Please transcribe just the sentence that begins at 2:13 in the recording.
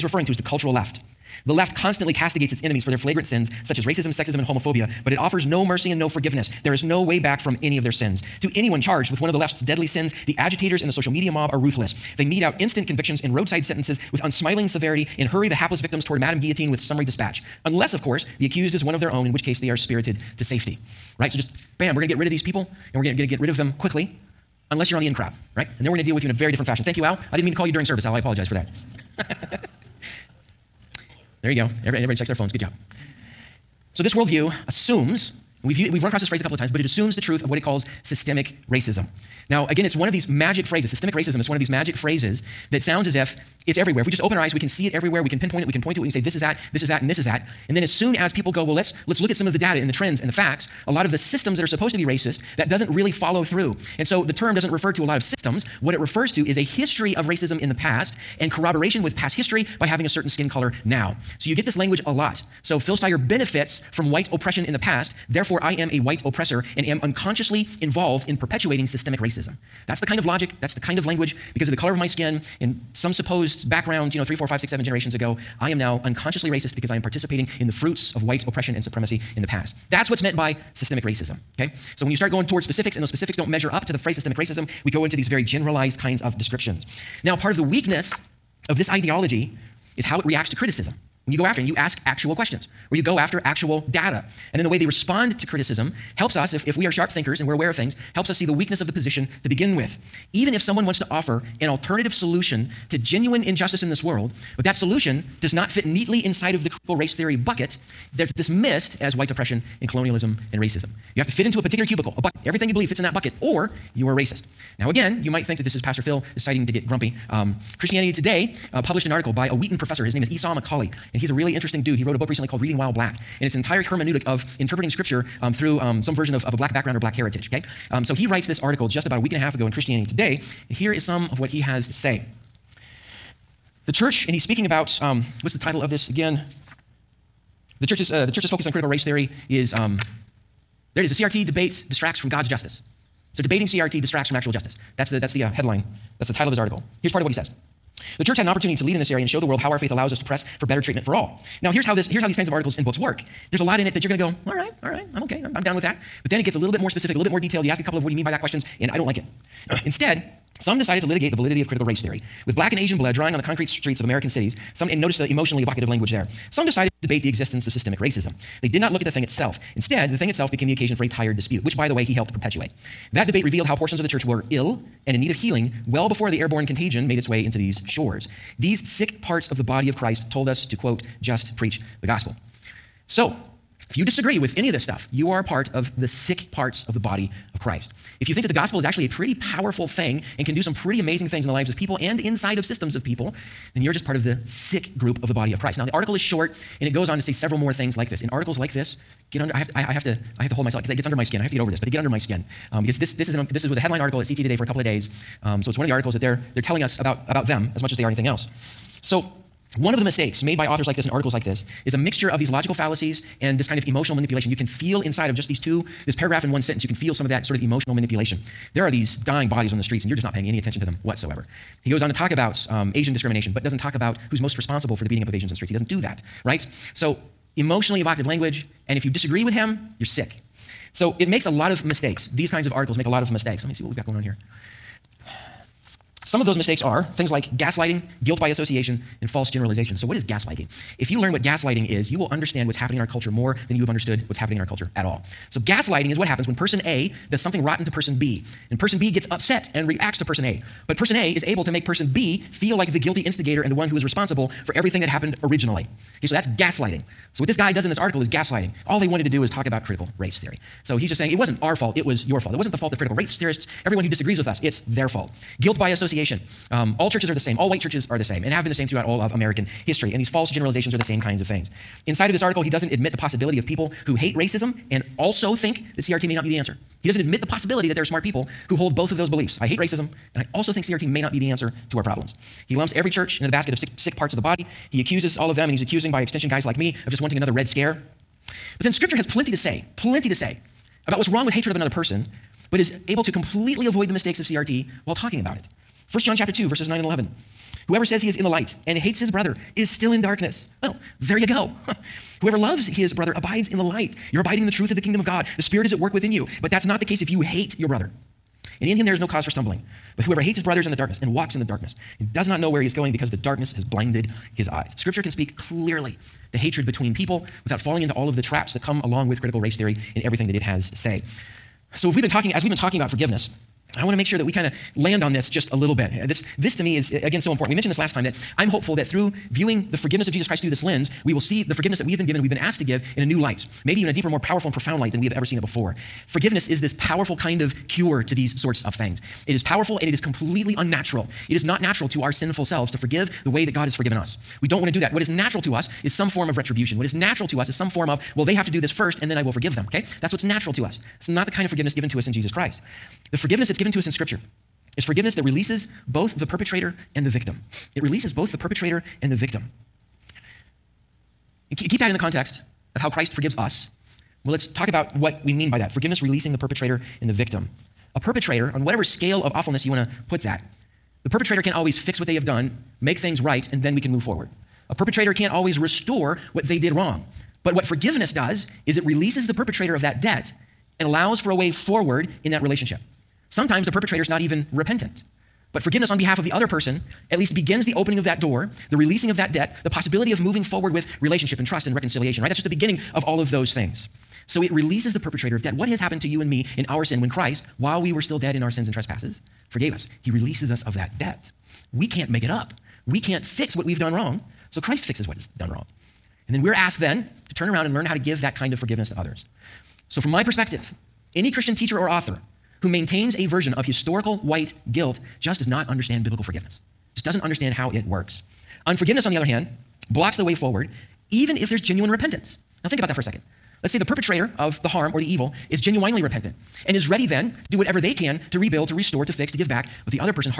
The church, and he's speaking about um, what's the title of this again?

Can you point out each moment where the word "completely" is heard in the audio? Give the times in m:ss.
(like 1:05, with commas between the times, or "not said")
4:53, 5:40.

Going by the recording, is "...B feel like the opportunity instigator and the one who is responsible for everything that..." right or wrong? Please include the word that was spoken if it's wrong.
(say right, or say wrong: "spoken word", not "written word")
wrong: "guilty", not "opportunity".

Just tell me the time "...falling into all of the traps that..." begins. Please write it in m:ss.
5:17.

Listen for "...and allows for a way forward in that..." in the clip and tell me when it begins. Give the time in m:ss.
6:20.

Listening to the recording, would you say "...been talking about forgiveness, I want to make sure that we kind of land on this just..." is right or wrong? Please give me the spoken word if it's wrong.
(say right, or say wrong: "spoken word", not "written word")
right.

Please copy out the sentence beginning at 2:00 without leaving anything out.
His name is Esau McCaulley, and he's a really interesting dude.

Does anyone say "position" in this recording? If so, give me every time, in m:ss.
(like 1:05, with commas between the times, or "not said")
1:38.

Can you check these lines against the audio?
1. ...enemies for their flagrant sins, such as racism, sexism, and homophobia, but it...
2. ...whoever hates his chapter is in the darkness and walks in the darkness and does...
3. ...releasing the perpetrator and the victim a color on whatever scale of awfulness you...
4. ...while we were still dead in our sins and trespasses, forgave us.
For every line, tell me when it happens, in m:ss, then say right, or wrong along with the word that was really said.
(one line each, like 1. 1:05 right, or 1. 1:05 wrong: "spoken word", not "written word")
1. 0:02 right
2. 5:10 wrong: "brother", not "chapter"
3. 6:06 wrong: "perpetrator", not "color"
4. 6:37 right.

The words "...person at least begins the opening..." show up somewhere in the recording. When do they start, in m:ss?
6:26.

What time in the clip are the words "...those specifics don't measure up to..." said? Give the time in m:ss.
1:23.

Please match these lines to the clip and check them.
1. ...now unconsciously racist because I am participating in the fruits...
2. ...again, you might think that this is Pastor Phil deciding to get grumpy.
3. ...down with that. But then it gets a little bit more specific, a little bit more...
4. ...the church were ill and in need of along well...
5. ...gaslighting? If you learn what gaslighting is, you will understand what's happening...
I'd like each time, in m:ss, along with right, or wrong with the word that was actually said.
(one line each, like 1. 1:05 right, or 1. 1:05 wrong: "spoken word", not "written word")
1. 1:15 right
2. 1:54 right
3. 2:35 right
4. 2:54 wrong: "healing", not "along"
5. 4:00 right.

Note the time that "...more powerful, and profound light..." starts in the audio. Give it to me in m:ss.
5:34.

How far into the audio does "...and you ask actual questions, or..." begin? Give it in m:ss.
1:31.